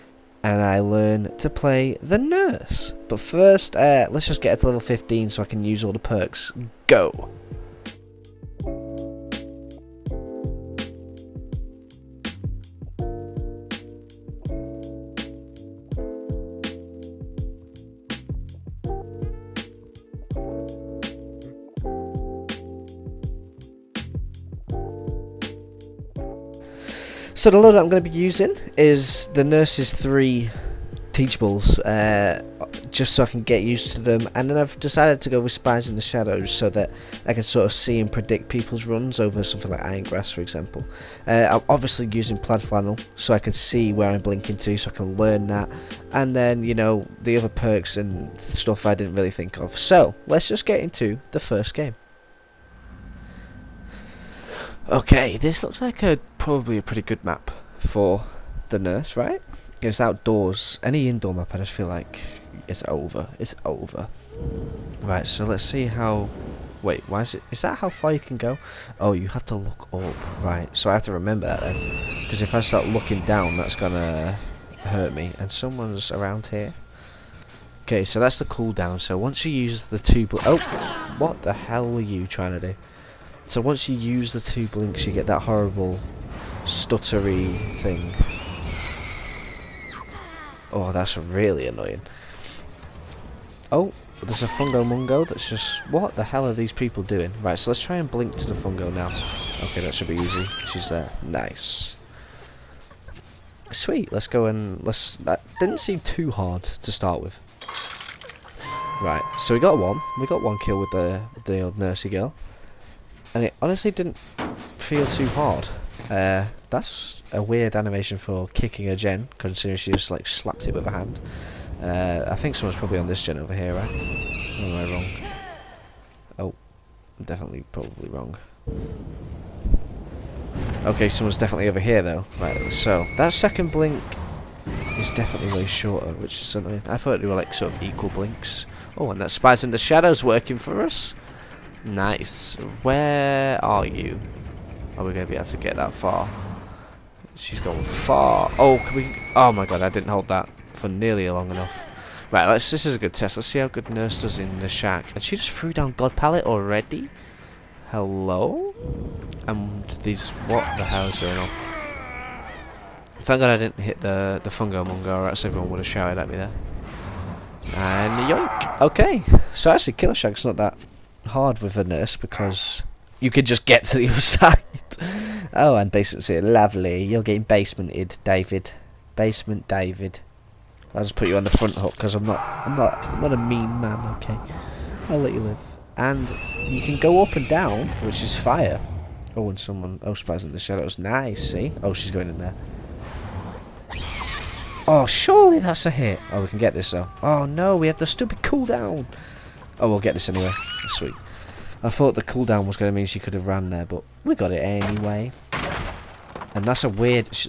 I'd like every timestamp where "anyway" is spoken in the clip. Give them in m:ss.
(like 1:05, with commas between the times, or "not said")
3:20, 3:24.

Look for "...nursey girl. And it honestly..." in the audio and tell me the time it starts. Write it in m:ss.
1:51.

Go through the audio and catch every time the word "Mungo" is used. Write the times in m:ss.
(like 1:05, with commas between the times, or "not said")
1:34, 2:44.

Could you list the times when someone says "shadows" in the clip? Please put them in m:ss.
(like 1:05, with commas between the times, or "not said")
0:36, 2:19, 3:10.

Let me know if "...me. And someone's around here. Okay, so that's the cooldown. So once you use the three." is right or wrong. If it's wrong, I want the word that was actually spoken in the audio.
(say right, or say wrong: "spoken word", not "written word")
wrong: "two", not "three".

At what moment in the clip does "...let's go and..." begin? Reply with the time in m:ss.
1:44.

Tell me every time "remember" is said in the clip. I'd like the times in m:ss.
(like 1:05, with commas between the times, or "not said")
1:11.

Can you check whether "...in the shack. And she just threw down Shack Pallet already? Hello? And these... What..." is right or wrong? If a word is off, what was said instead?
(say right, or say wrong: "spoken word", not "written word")
wrong: "God", not "Shack".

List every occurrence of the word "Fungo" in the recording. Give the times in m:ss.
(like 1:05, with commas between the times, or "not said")
1:34, 1:38, 2:44.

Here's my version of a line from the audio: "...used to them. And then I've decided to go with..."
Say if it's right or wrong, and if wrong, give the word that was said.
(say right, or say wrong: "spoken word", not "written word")
right.